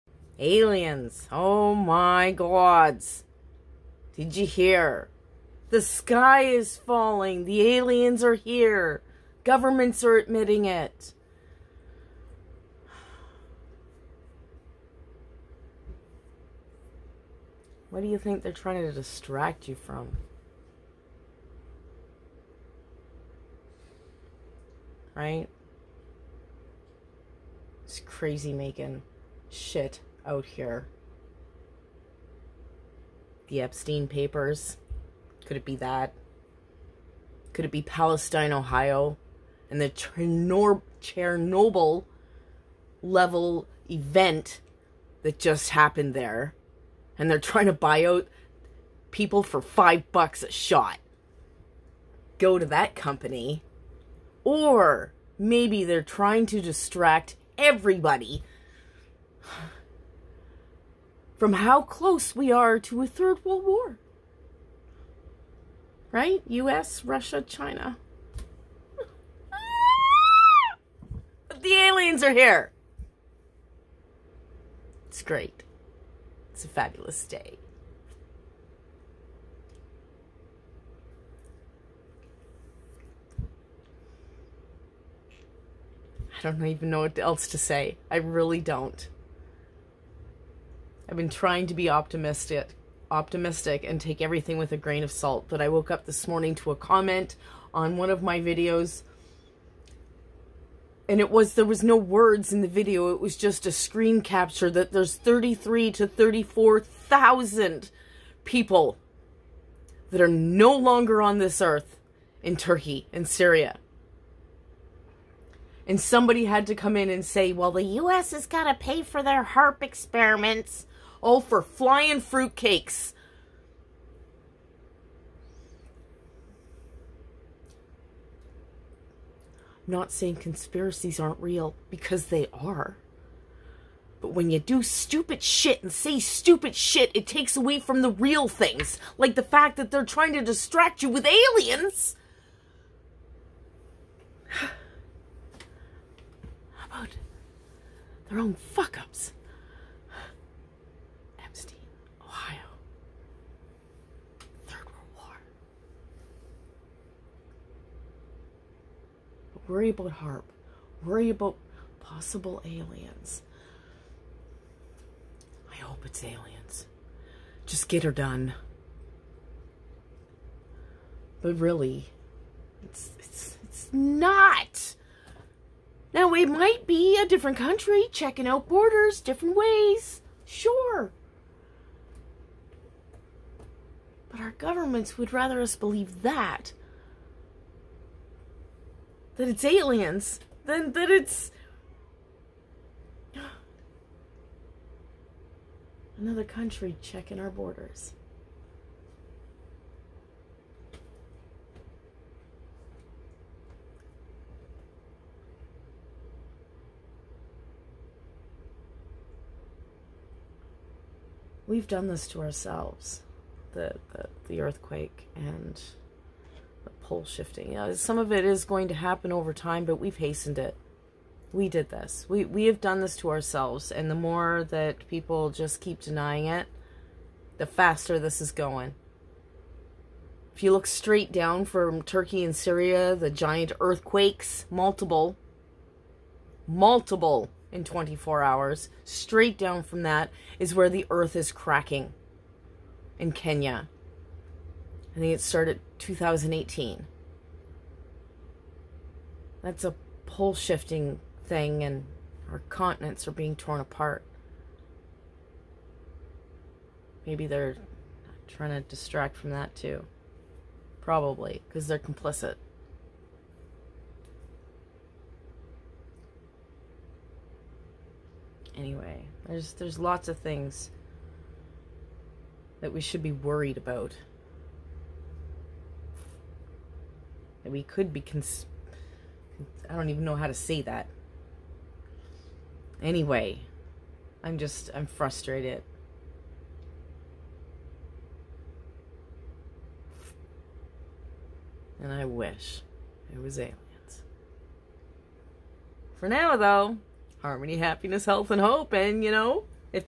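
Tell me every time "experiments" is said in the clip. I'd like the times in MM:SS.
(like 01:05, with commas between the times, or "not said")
01:59.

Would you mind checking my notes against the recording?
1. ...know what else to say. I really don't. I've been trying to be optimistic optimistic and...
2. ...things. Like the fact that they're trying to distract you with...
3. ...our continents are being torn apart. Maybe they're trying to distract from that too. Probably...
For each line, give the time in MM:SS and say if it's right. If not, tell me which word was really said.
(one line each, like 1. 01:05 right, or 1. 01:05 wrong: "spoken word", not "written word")
1. 01:26 right
2. 02:18 right
3. 04:12 right.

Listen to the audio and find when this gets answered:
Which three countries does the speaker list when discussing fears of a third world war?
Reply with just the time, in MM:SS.
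01:06.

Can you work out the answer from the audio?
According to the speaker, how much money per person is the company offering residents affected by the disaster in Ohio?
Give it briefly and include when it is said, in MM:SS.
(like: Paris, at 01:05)
$5, at 00:49.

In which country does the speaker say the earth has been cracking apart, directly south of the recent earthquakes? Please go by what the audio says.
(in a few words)
Kenya.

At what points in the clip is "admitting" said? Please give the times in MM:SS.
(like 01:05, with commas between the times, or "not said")
00:10.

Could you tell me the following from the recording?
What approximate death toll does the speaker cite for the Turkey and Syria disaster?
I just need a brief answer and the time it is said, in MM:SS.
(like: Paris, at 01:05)
33,000 to 34,000, at 01:45.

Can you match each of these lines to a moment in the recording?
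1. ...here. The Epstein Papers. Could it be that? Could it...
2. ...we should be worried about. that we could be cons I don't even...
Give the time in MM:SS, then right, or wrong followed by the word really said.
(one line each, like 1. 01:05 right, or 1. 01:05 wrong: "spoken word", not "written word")
1. 00:30 right
2. 04:32 right.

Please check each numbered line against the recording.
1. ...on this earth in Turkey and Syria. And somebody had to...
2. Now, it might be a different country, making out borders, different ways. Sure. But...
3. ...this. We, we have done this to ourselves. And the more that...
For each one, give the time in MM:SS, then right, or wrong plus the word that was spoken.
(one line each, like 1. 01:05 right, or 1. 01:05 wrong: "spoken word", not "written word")
1. 01:51 right
2. 02:56 wrong: "checking", not "making"
3. 03:41 right.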